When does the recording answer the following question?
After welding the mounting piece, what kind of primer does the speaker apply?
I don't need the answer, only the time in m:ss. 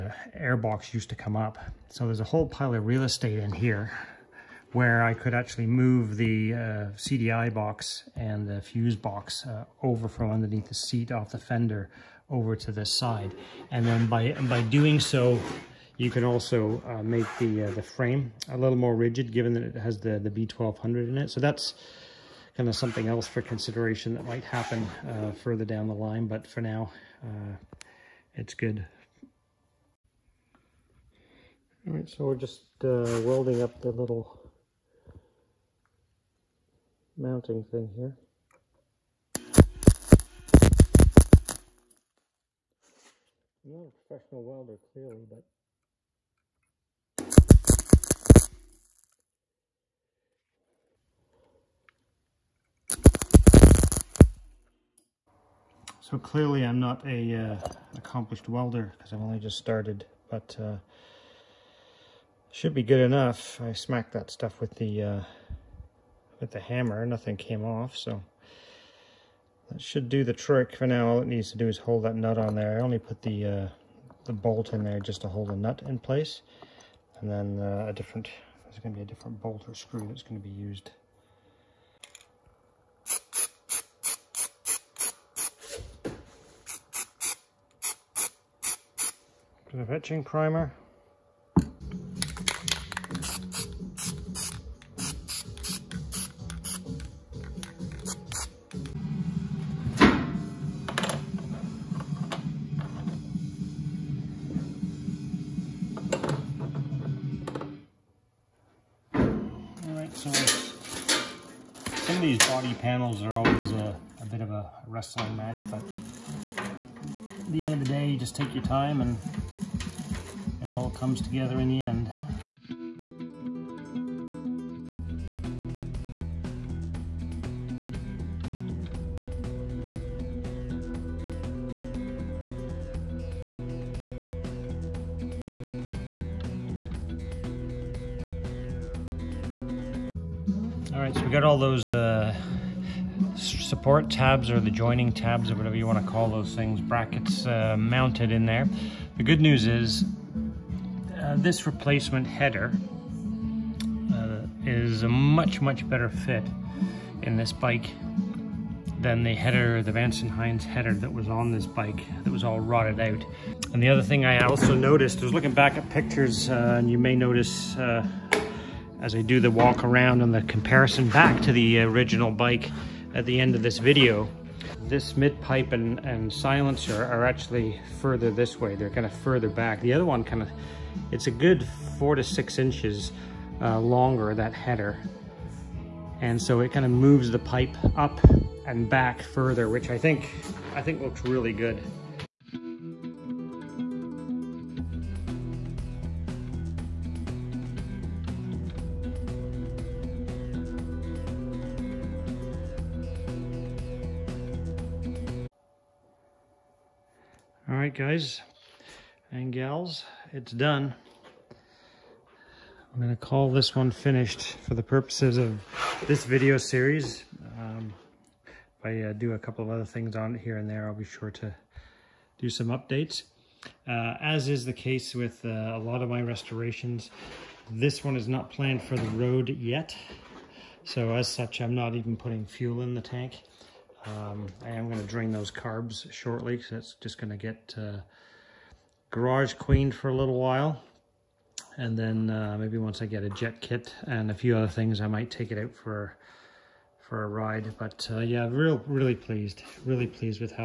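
1:29.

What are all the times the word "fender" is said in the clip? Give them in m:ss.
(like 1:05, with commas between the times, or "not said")
0:11.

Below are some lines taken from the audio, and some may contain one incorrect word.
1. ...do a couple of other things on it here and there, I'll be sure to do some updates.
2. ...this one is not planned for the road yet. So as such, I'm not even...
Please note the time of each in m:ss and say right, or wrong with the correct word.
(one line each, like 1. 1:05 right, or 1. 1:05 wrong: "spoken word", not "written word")
1. 3:39 right
2. 3:47 right.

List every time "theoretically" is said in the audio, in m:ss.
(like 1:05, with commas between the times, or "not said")
not said.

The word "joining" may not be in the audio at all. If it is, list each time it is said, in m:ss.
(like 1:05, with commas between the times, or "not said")
2:24.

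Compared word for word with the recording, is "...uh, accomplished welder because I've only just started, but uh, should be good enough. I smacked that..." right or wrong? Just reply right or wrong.
right.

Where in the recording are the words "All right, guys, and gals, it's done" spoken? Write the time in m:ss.
3:27.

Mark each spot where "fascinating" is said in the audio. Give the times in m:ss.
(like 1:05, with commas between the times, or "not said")
not said.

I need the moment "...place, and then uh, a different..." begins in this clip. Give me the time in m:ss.
1:15.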